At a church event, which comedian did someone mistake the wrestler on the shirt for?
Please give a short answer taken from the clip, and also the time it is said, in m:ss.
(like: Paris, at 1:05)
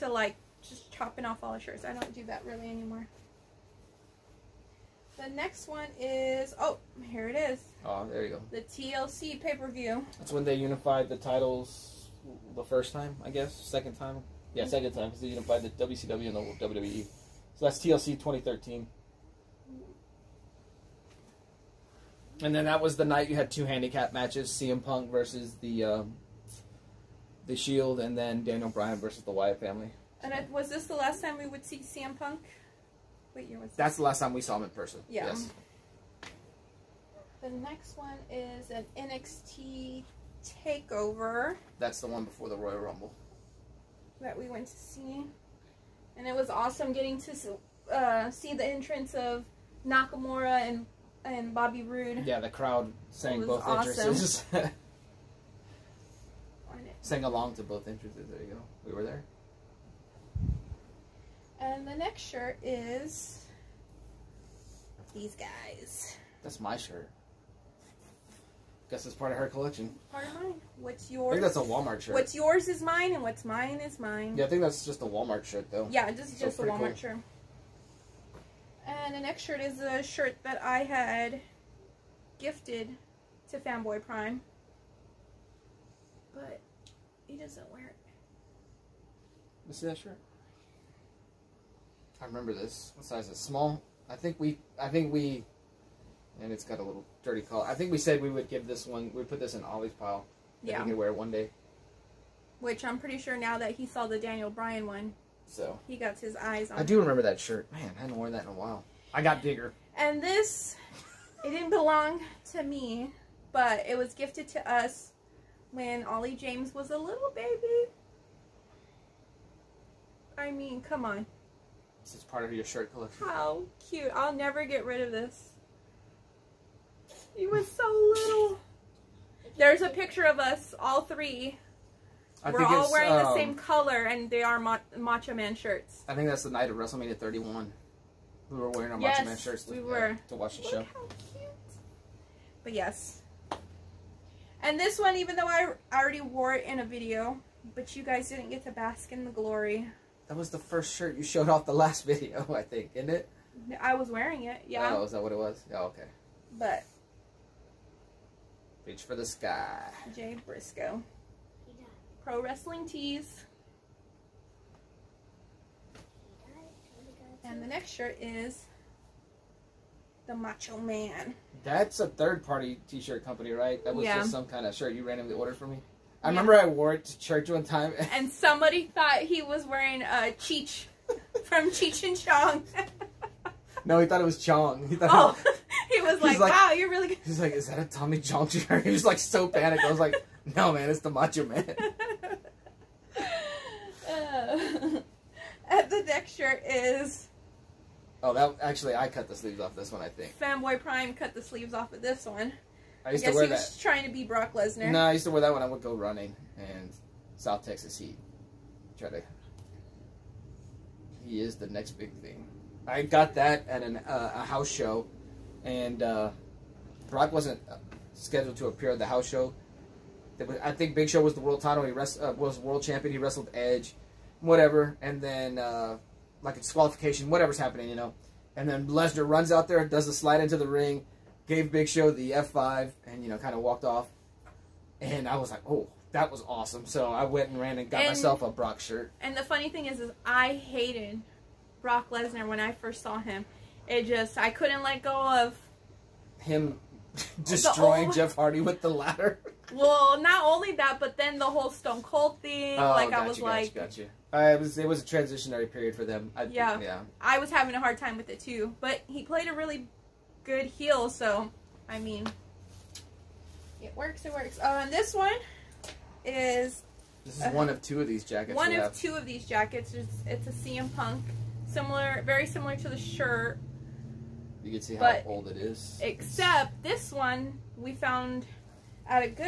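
Tommy Chong, at 3:07.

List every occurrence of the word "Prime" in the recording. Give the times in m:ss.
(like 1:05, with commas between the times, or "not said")
1:24, 3:20.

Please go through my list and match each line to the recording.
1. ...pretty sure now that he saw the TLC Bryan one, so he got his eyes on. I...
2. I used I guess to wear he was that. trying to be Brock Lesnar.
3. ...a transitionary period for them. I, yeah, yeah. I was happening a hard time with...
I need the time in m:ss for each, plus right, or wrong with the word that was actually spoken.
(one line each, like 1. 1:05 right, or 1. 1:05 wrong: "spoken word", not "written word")
1. 1:42 wrong: "Daniel", not "TLC"
2. 3:23 right
3. 4:15 wrong: "having", not "happening".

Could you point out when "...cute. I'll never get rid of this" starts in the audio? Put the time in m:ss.
2:03.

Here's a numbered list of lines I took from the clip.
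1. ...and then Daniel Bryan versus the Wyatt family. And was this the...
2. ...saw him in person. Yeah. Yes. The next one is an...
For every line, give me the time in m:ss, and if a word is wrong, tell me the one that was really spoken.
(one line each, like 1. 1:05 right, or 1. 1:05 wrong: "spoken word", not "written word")
1. 0:27 right
2. 0:34 right.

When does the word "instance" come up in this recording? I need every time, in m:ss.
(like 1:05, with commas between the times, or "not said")
not said.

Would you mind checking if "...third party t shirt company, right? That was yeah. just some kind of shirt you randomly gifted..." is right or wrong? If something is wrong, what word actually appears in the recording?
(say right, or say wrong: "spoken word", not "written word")
wrong: "ordered", not "gifted".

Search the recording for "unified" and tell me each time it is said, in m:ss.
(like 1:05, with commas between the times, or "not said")
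0:10, 0:15.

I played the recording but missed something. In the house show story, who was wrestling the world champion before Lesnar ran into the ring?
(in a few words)
Edge.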